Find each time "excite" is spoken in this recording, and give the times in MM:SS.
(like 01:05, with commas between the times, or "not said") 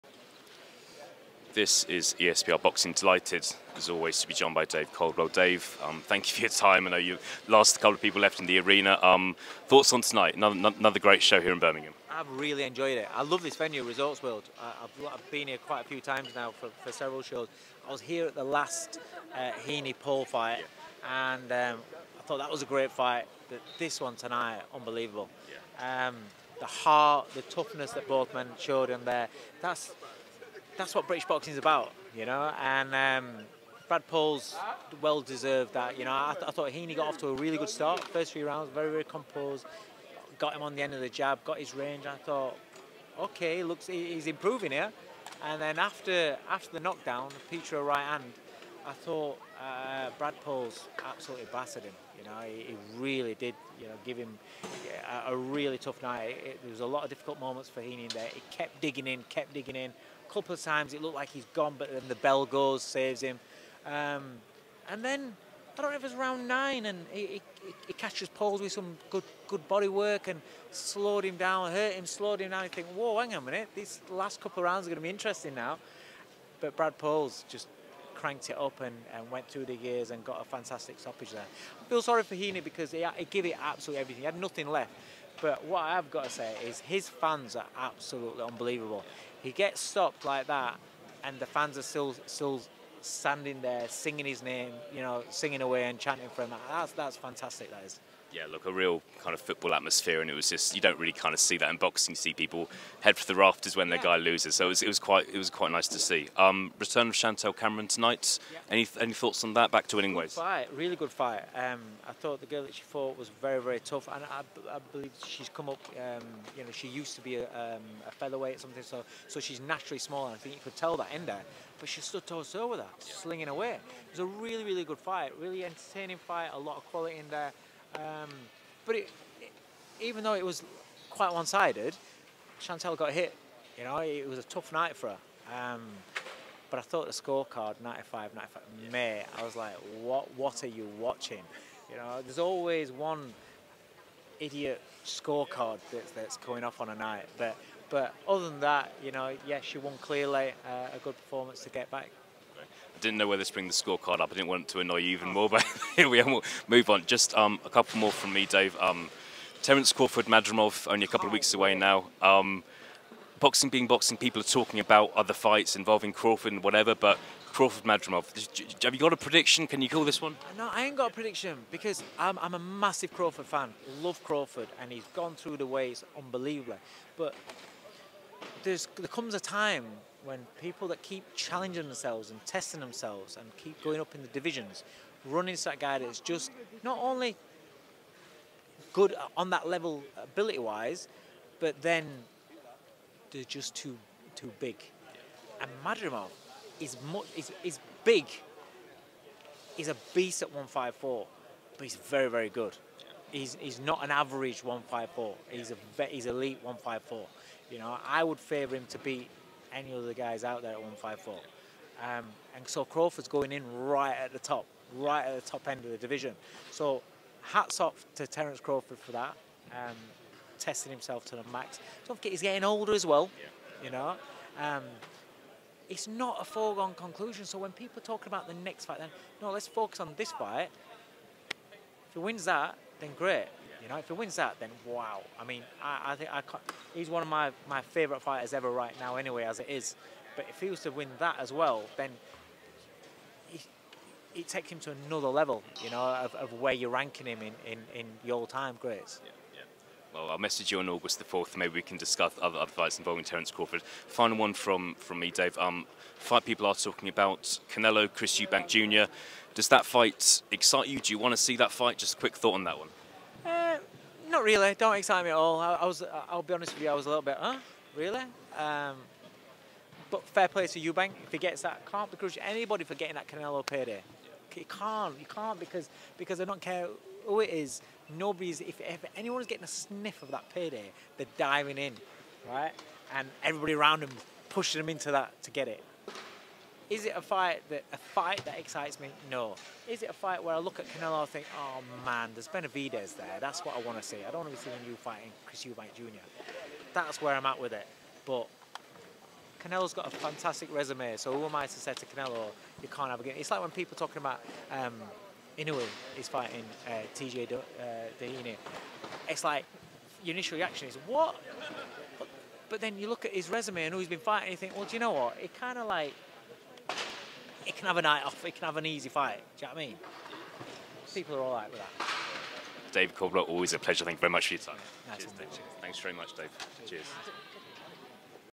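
04:20, 04:24, 04:48.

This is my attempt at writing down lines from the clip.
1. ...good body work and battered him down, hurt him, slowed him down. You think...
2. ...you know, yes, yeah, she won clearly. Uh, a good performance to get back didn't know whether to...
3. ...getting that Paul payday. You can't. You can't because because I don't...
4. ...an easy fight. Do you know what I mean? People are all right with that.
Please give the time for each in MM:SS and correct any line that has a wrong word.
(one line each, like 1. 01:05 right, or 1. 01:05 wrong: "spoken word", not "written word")
1. 01:09 wrong: "slowed", not "battered"
2. 02:29 right
3. 04:32 wrong: "Canelo", not "Paul"
4. 05:18 right.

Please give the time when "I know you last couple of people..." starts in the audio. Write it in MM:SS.
00:06.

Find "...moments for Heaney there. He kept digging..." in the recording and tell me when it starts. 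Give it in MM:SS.
00:57.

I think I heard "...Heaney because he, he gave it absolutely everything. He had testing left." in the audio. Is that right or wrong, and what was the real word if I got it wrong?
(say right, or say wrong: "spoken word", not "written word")
wrong: "nothing", not "testing".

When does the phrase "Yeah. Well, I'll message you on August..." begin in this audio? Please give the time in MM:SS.
04:09.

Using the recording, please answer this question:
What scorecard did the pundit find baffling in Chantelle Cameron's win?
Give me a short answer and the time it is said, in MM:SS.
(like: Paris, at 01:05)
95-95, at 02:17.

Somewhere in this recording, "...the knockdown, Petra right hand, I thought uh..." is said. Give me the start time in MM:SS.
00:46.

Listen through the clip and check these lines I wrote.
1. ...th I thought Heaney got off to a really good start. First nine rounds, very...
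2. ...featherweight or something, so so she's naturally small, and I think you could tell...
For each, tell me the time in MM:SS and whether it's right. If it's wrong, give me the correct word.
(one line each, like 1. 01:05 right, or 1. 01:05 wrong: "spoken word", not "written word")
1. 00:36 wrong: "three", not "nine"
2. 01:58 right.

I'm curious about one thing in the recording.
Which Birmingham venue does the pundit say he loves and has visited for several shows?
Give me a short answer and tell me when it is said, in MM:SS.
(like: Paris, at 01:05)
Resorts World, at 00:13.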